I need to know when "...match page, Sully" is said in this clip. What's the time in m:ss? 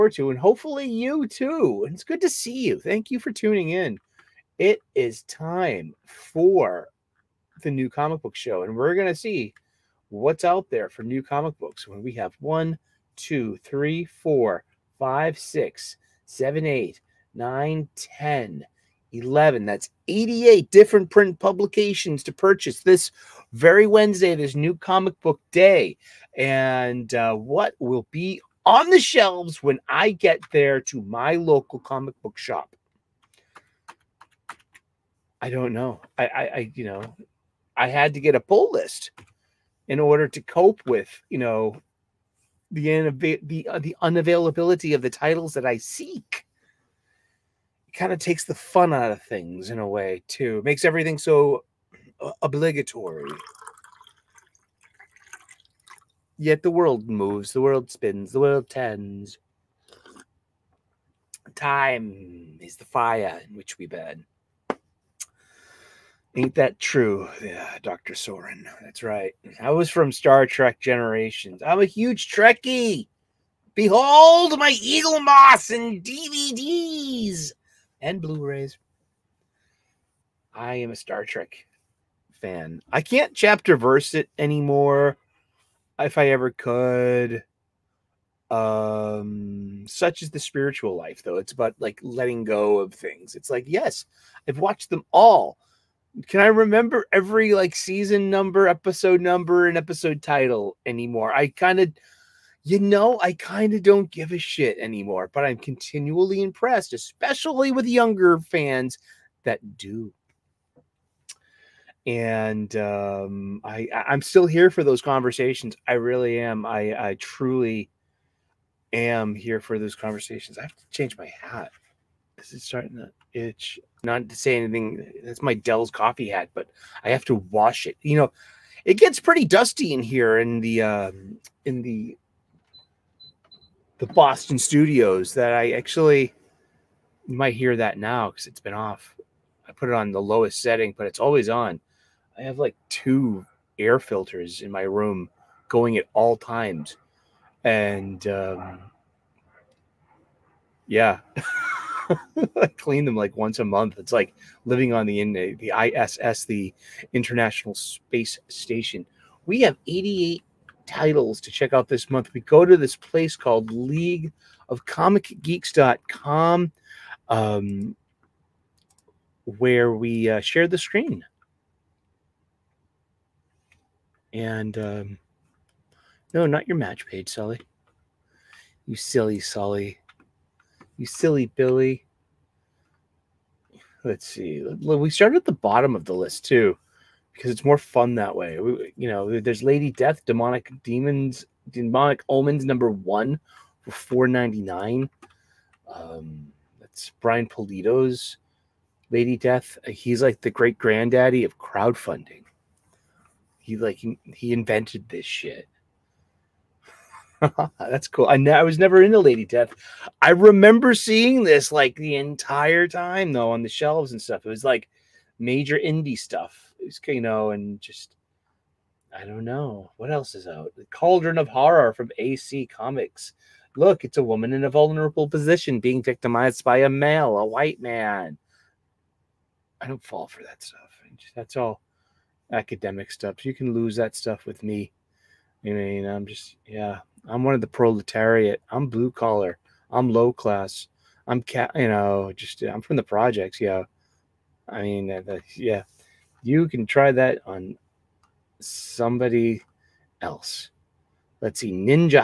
2:56.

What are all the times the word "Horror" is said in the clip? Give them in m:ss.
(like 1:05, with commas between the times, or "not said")
3:41.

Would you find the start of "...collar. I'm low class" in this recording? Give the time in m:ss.
3:59.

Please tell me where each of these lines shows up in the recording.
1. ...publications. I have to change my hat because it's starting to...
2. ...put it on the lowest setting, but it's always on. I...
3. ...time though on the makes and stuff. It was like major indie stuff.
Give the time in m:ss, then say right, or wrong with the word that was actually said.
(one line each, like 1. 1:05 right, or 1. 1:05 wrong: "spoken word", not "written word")
1. 1:59 wrong: "conversations", not "publications"
2. 2:19 right
3. 3:32 wrong: "shelves", not "makes".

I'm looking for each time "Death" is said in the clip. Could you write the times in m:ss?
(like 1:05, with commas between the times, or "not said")
3:09, 3:19, 3:29.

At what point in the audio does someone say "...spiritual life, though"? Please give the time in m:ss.
1:30.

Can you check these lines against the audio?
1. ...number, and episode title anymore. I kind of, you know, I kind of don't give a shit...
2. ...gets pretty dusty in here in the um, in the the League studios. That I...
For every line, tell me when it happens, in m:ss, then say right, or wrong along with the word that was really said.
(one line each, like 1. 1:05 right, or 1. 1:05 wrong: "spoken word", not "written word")
1. 1:39 right
2. 2:08 wrong: "Boston", not "League".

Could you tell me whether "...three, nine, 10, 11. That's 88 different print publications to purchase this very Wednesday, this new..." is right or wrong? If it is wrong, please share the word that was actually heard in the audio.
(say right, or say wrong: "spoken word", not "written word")
wrong: "eight", not "three".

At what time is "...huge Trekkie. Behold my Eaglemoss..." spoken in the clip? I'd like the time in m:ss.
1:11.